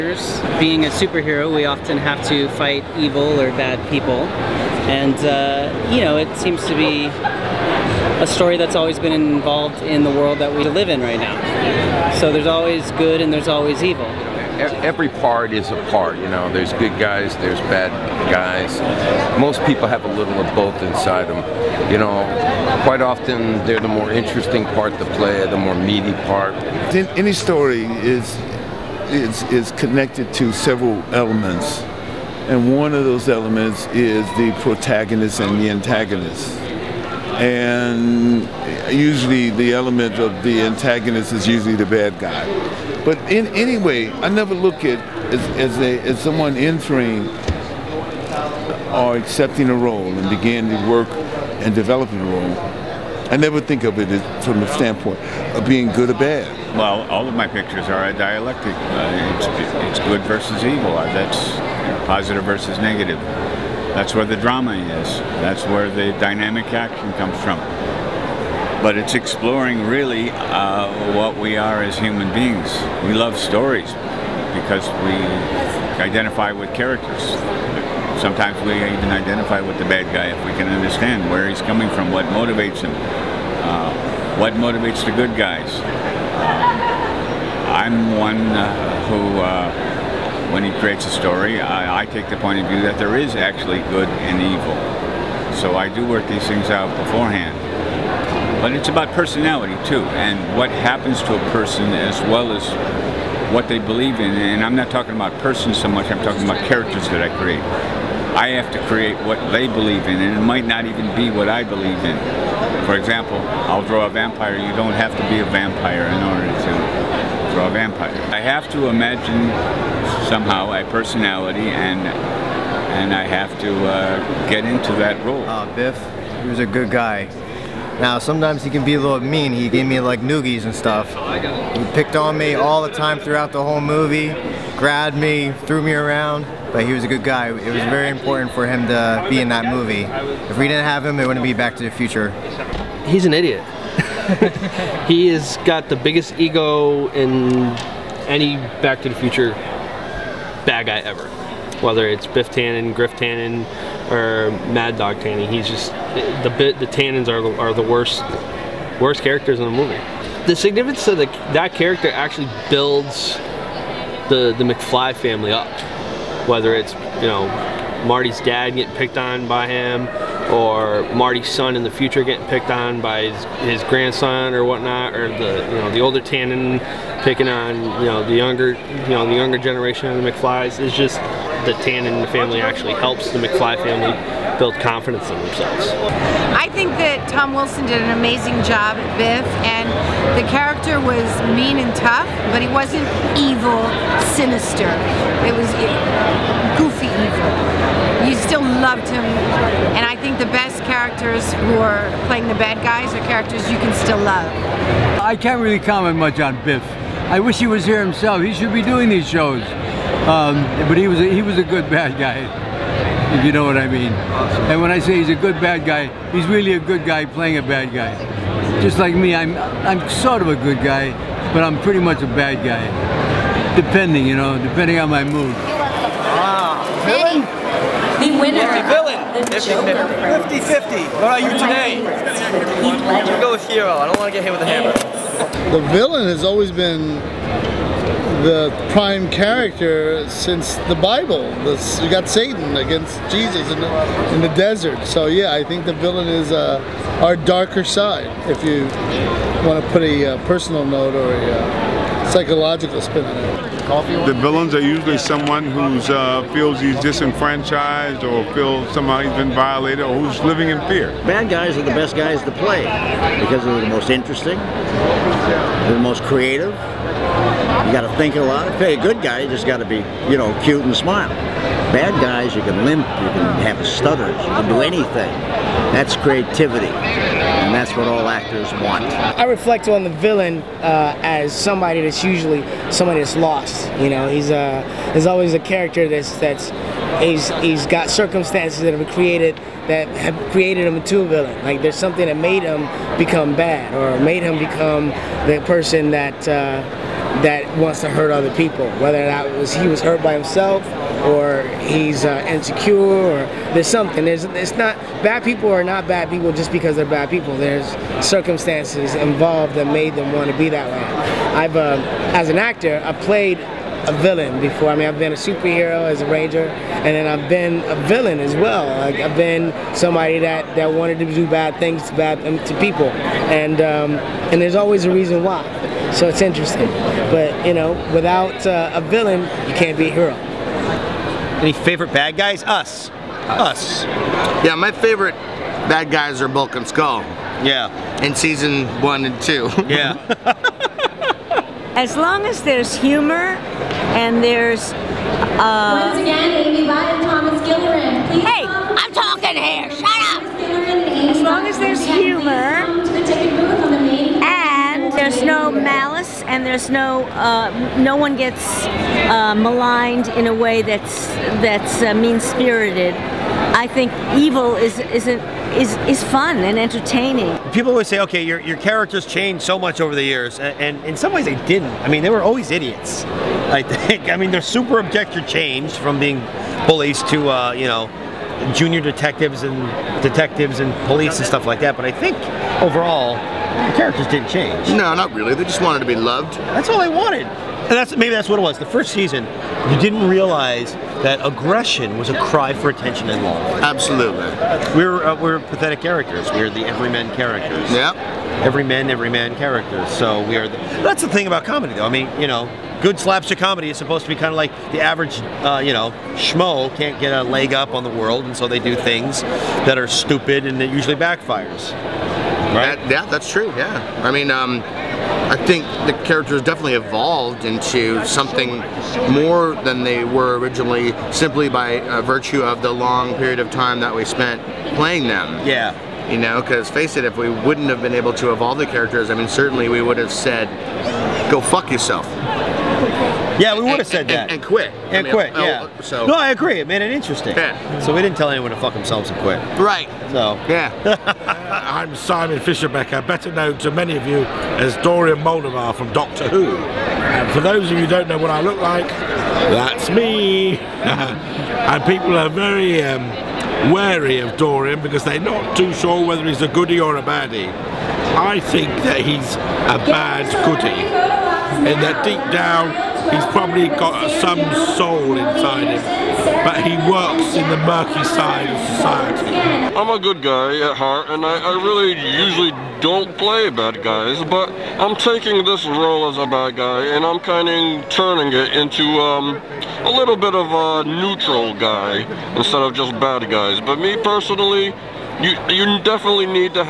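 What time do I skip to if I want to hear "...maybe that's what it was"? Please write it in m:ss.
6:28.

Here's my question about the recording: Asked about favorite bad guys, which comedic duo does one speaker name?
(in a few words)
Bulk and Skull.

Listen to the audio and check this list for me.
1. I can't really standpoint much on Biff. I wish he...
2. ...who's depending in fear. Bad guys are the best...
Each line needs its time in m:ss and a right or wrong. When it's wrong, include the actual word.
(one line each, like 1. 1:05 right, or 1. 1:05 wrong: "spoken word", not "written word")
1. 3:25 wrong: "comment", not "standpoint"
2. 4:20 wrong: "living", not "depending".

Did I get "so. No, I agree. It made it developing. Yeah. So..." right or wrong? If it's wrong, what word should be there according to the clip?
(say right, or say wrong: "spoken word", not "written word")
wrong: "interesting", not "developing".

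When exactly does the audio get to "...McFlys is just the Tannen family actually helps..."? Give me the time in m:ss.
3:00.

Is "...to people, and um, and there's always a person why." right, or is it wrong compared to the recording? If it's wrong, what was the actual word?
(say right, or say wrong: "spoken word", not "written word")
wrong: "reason", not "person".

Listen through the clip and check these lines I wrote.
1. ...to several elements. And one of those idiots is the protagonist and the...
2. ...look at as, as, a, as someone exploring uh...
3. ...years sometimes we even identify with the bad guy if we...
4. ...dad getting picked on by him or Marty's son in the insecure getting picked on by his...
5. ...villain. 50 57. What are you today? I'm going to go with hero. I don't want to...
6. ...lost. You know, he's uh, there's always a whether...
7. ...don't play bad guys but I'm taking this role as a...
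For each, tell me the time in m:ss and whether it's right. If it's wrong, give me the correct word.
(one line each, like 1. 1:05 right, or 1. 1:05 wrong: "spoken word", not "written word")
1. 0:30 wrong: "elements", not "idiots"
2. 0:44 wrong: "entering", not "exploring"
3. 1:16 wrong: "characters", not "years"
4. 2:48 wrong: "future", not "insecure"
5. 3:48 wrong: "50", not "57"
6. 4:43 wrong: "character", not "whether"
7. 7:53 right.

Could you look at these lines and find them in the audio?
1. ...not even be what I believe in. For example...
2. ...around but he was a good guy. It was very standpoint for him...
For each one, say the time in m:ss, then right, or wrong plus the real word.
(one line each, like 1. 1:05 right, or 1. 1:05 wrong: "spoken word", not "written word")
1. 1:50 right
2. 2:15 wrong: "important", not "standpoint".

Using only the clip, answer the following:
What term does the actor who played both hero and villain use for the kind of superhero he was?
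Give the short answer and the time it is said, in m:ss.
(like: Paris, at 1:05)
ranger, at 5:16.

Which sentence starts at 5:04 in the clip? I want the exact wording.
There's it's not bad people are not bad people just because they're bad people.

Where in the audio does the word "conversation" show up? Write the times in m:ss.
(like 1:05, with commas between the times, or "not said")
not said.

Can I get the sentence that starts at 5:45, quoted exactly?
Uh, Once again, Amy Bott and Thomas Gillerin.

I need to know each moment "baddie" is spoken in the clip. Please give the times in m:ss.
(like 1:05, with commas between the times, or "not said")
7:37.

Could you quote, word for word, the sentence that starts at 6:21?
But I think overall the characters didn't change.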